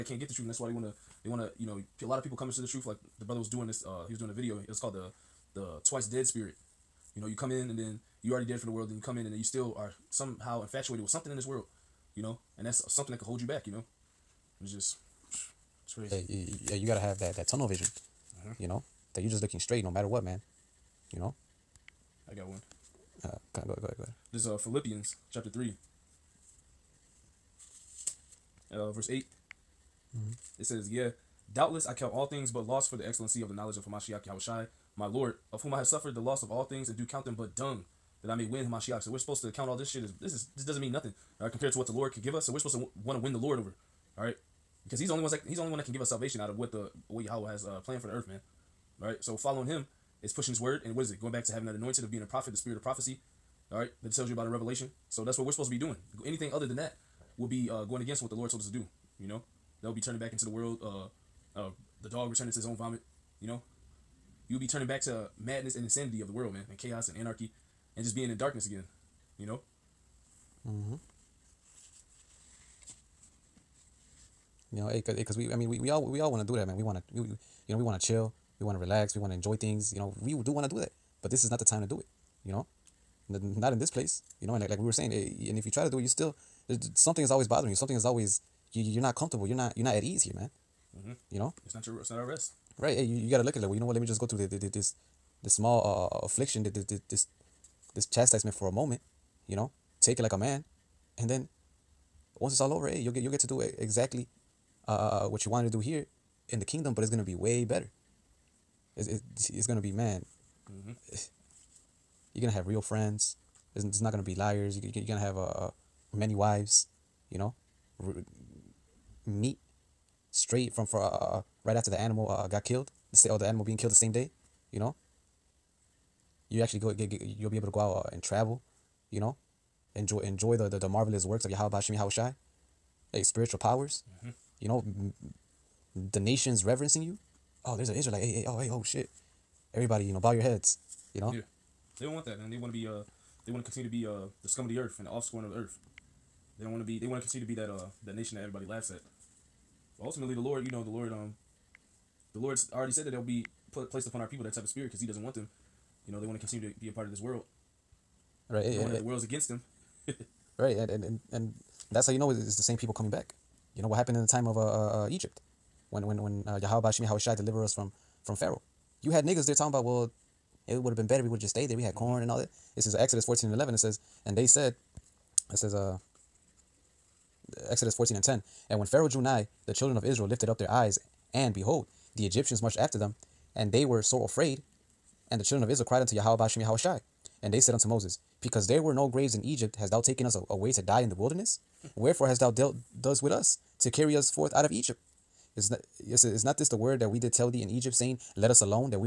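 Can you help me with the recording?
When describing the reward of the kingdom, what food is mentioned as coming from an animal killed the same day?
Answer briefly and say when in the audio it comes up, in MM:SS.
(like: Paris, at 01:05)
Meat, at 01:59.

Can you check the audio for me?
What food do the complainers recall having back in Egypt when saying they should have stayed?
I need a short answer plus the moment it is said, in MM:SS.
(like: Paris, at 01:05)
Corn, at 02:51.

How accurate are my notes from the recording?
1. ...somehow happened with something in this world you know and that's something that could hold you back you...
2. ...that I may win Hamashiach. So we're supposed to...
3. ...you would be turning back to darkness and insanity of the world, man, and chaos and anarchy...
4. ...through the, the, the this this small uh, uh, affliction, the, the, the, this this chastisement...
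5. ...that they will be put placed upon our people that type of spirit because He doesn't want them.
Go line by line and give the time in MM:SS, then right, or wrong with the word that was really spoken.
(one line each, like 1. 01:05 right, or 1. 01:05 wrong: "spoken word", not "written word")
1. 00:10 wrong: "infatuated", not "happened"
2. 00:38 right
3. 01:04 wrong: "madness", not "darkness"
4. 01:34 right
5. 02:33 right.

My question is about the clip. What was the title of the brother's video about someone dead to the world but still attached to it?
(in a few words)
The Twice Dead Spirit.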